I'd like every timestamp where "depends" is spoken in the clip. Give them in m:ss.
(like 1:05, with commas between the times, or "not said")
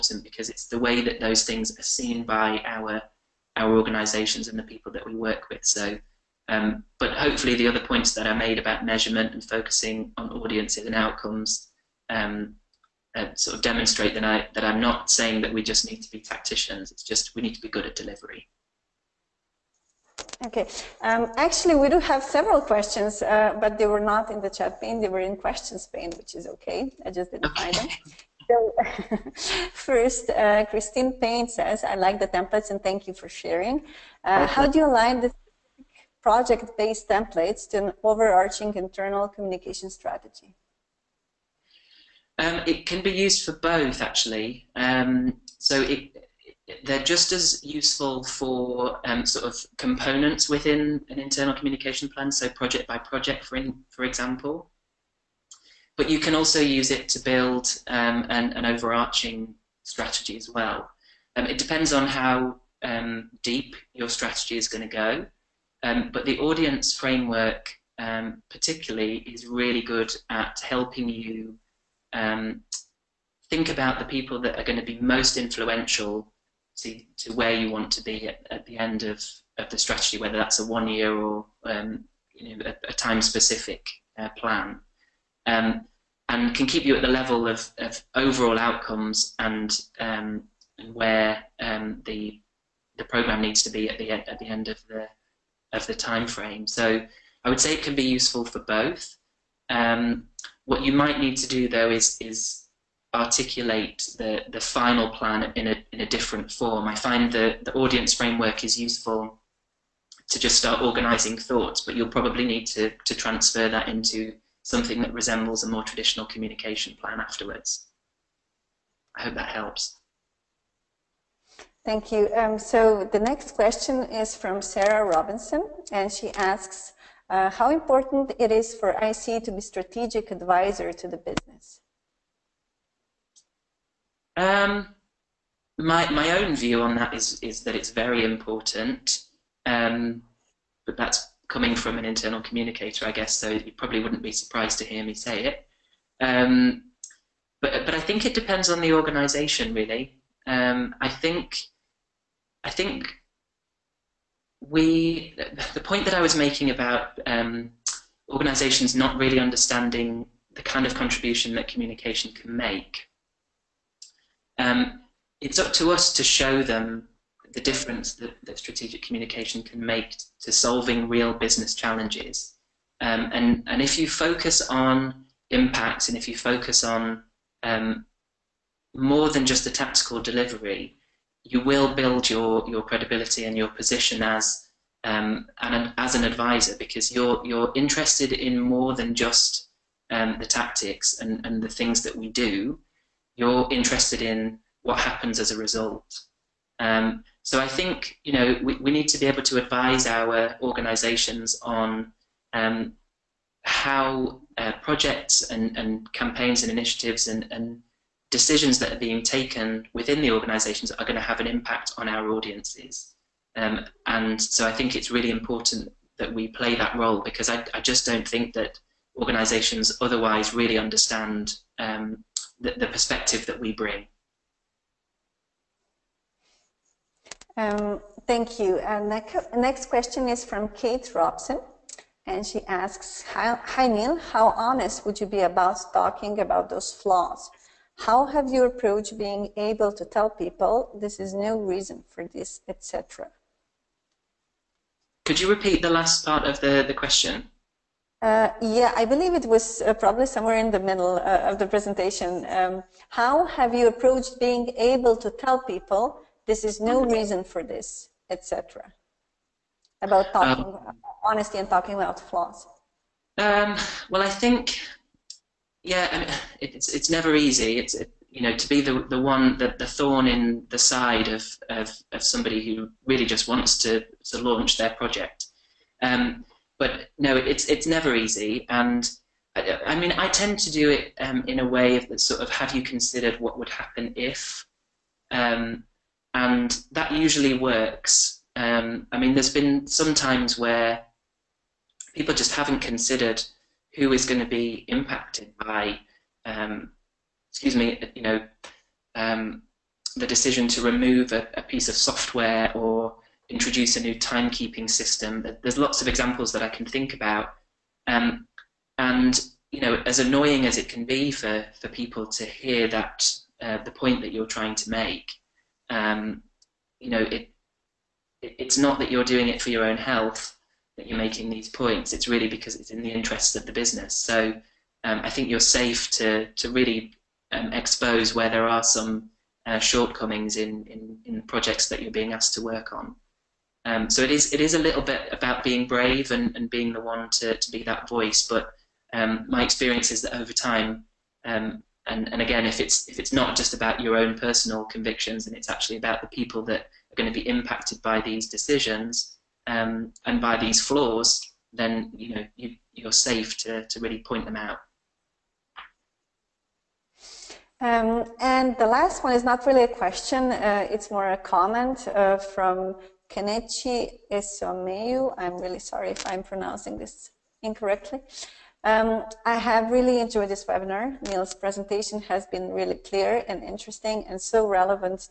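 1:01, 2:28.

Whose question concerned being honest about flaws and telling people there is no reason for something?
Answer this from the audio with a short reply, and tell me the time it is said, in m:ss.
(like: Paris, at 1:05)
Kate Robson, at 3:50.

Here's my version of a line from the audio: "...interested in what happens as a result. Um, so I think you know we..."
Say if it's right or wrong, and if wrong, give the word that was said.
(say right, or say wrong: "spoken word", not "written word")
right.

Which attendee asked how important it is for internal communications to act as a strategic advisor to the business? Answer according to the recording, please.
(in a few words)
Sarah Robinson.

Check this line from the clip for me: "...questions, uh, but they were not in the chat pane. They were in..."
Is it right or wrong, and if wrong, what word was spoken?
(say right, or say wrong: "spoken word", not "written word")
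right.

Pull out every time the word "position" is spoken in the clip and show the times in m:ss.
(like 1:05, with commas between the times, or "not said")
3:03.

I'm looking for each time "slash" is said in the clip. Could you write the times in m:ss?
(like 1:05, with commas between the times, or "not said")
not said.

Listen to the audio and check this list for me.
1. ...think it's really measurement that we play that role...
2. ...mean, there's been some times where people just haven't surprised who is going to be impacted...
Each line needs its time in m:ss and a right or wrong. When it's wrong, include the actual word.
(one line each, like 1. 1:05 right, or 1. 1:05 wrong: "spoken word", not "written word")
1. 3:34 wrong: "important", not "measurement"
2. 4:49 wrong: "considered", not "surprised".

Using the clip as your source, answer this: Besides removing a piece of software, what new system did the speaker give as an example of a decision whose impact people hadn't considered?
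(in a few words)
timekeeping system.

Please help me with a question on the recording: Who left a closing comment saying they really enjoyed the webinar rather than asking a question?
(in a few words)
Kenichi Esomeu.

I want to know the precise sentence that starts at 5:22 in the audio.
It's really because it's in the interests of the business.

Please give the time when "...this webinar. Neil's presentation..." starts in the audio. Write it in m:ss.
6:10.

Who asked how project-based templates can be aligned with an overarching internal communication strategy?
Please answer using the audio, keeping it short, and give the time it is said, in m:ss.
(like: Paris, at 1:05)
Christine Payne, at 0:30.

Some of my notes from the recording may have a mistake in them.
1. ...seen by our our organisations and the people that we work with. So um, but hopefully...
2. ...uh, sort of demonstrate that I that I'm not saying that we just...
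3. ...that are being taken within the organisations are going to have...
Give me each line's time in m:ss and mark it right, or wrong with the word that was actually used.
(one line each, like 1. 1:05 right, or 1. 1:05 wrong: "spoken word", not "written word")
1. 0:01 right
2. 0:13 right
3. 3:28 right.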